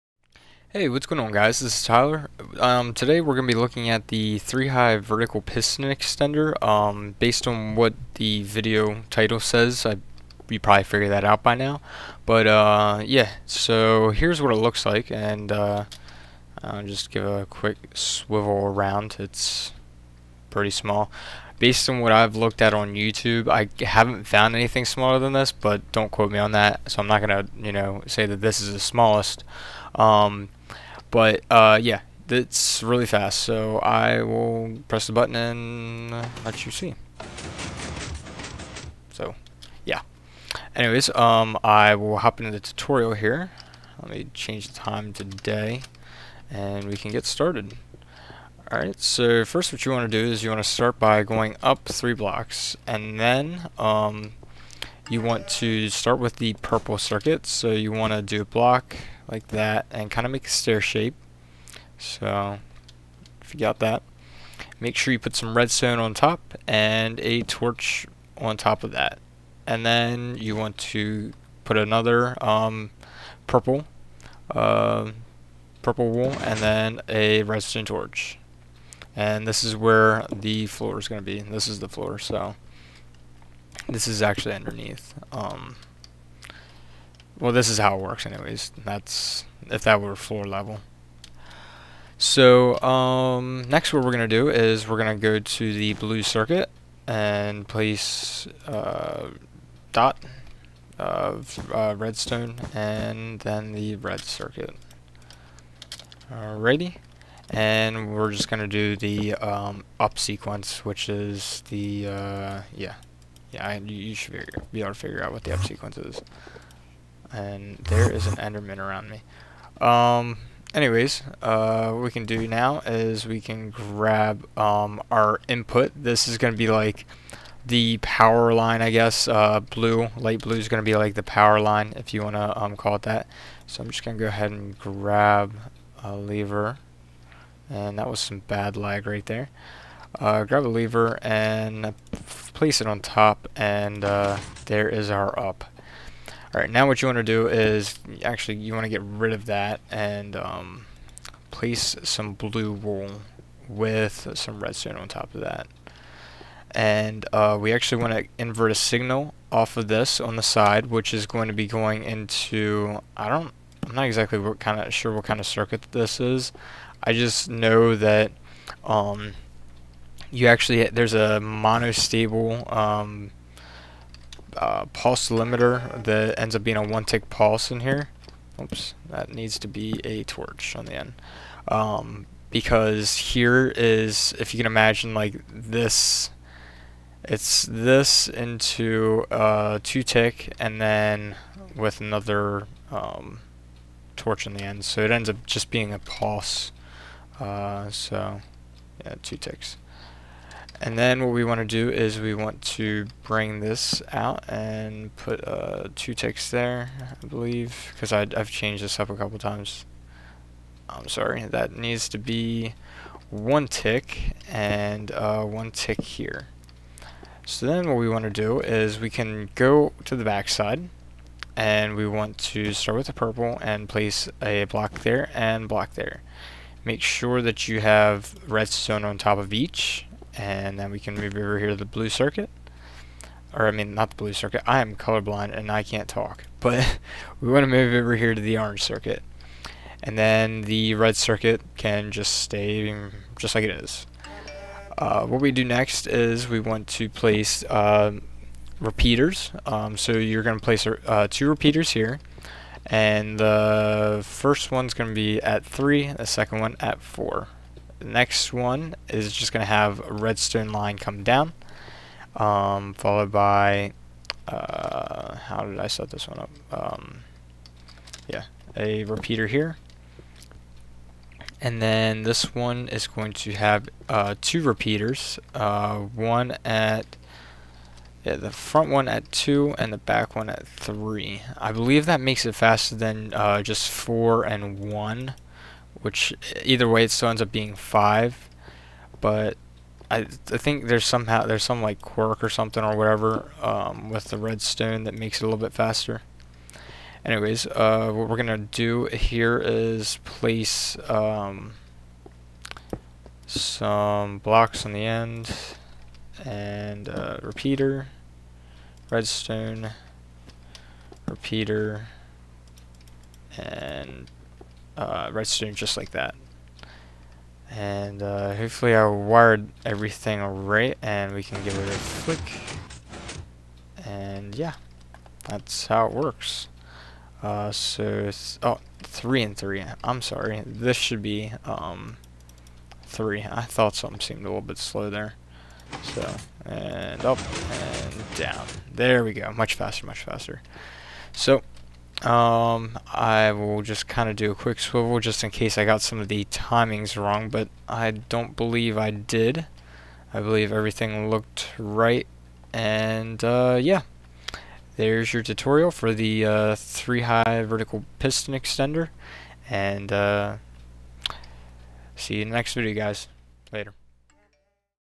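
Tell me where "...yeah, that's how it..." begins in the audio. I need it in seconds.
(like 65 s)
324 s.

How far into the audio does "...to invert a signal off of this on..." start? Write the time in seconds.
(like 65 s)
158 s.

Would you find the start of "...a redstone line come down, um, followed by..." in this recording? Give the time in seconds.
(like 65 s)
259 s.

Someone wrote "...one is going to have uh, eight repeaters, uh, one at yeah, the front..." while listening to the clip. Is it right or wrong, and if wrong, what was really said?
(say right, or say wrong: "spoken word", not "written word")
wrong: "two", not "eight".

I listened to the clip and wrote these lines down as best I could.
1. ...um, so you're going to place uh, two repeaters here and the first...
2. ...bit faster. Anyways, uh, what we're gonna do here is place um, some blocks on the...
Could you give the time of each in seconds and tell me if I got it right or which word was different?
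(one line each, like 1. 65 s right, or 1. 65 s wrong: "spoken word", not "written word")
1. 249 s right
2. 295 s right.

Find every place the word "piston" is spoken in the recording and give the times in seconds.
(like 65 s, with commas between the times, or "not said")
5 s, 358 s.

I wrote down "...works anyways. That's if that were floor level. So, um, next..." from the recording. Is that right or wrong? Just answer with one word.
right.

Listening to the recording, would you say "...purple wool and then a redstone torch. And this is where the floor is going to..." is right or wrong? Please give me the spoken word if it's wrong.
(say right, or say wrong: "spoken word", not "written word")
right.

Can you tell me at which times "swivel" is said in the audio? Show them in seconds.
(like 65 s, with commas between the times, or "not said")
17 s, 344 s.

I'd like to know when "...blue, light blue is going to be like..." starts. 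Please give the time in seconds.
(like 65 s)
129 s.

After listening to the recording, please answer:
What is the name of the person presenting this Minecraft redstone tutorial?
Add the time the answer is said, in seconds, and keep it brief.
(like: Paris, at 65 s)
Tyler, at 1 s.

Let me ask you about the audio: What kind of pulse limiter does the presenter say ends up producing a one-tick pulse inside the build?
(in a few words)
monostable.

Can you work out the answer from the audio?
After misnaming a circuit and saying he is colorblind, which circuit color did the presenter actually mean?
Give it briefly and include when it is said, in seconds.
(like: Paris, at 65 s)
orange, at 238 s.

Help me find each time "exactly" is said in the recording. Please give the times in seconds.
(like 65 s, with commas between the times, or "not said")
164 s.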